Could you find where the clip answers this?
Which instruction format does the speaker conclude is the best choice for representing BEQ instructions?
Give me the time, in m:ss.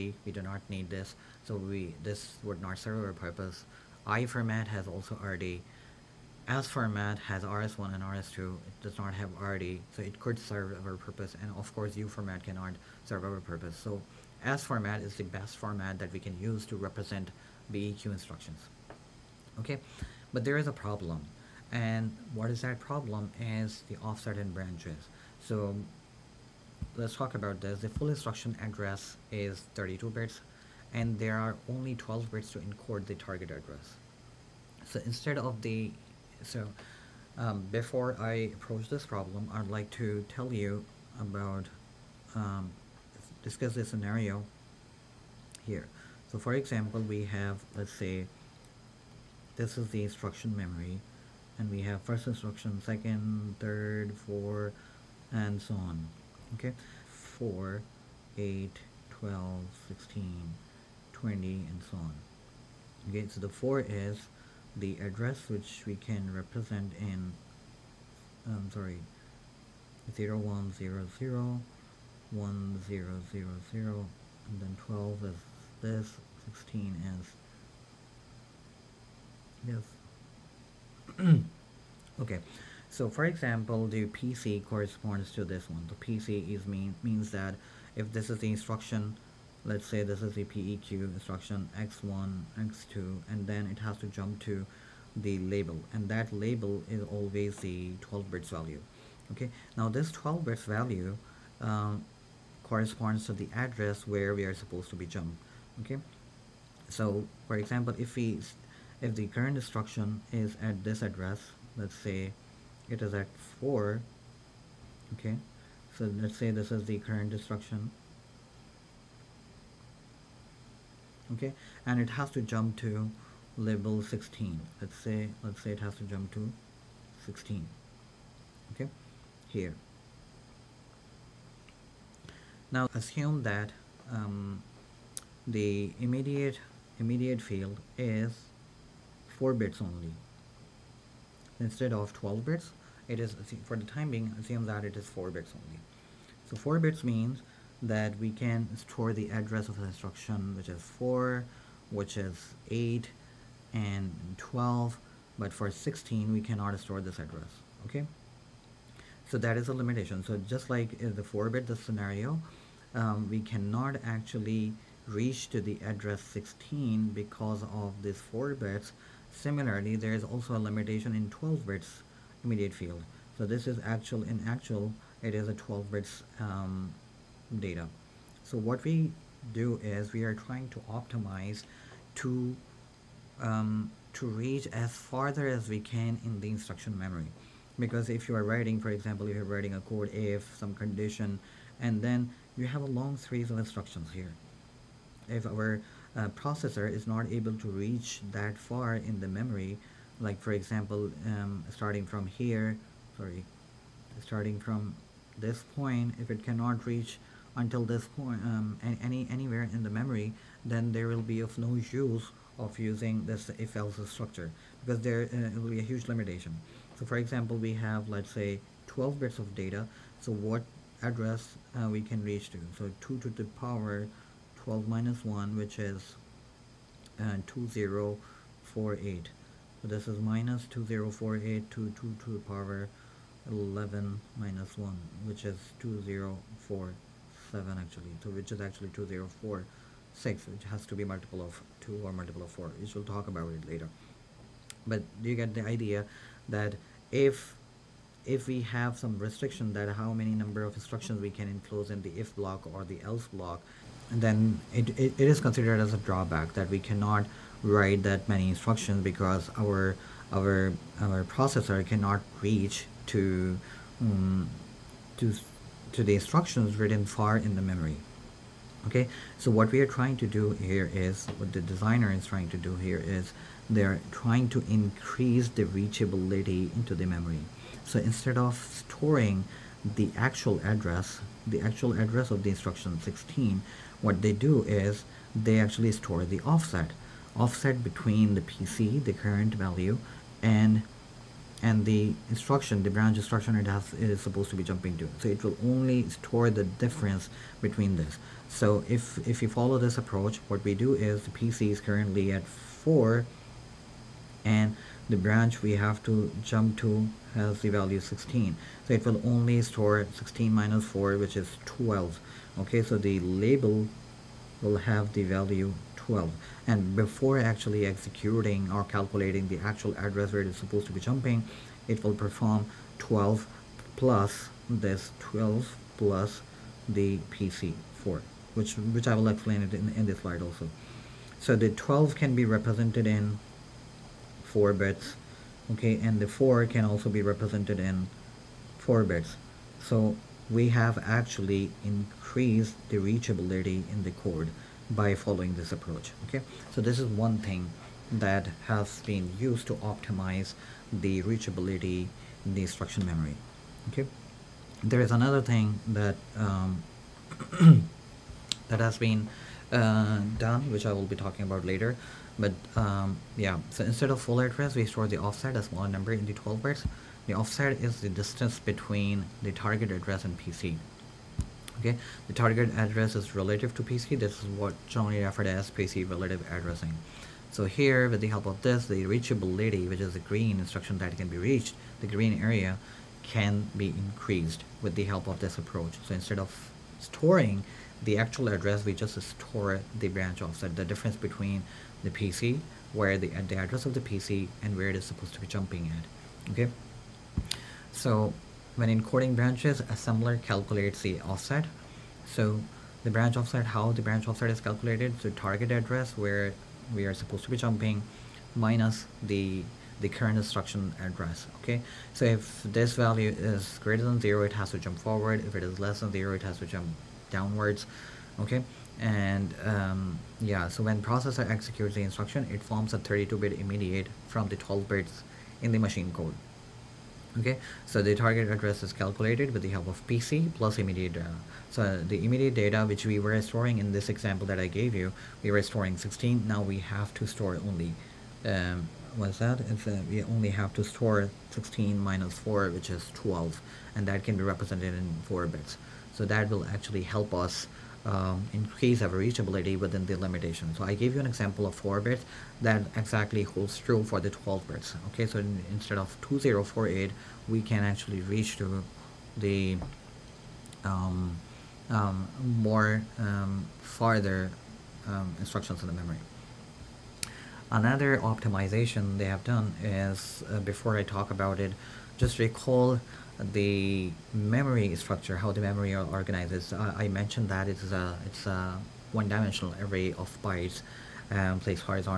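0:14.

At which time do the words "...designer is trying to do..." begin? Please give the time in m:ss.
4:31.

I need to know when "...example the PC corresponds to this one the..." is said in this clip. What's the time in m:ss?
1:23.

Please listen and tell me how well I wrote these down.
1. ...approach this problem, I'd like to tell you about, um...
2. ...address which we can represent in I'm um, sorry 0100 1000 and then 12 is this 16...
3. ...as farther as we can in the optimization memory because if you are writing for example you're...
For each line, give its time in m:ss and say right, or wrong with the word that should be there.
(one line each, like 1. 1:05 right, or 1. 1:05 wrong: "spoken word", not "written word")
1. 0:38 right
2. 1:05 right
3. 3:04 wrong: "instruction", not "optimization".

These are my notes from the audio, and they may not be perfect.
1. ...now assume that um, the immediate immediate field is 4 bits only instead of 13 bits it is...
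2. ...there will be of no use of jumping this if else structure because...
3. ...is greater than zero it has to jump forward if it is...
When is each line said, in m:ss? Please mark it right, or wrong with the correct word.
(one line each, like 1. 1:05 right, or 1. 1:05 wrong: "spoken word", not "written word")
1. 2:12 wrong: "12", not "13"
2. 3:30 wrong: "using", not "jumping"
3. 6:53 right.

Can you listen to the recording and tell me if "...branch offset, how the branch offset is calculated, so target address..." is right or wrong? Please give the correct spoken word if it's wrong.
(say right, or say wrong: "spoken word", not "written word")
right.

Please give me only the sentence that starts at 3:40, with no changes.
So what address uh, we can reach to?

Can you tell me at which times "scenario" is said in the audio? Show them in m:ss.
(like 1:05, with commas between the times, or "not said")
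0:43, 2:41.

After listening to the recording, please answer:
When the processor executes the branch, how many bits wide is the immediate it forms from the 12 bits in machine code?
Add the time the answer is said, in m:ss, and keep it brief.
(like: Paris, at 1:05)
32, at 7:02.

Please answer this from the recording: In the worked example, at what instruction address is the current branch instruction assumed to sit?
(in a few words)
4.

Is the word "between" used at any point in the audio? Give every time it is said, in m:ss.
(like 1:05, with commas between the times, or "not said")
4:47, 4:57, 6:08, 6:31.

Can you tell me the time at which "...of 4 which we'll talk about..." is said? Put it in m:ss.
4:02.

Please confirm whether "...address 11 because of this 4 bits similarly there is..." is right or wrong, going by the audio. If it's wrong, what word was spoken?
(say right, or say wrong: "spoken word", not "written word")
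wrong: "16", not "11".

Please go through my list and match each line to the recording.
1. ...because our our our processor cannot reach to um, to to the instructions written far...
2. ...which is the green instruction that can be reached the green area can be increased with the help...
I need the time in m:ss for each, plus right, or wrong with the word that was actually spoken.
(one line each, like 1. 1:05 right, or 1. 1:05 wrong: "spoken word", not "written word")
1. 4:19 right
2. 6:19 right.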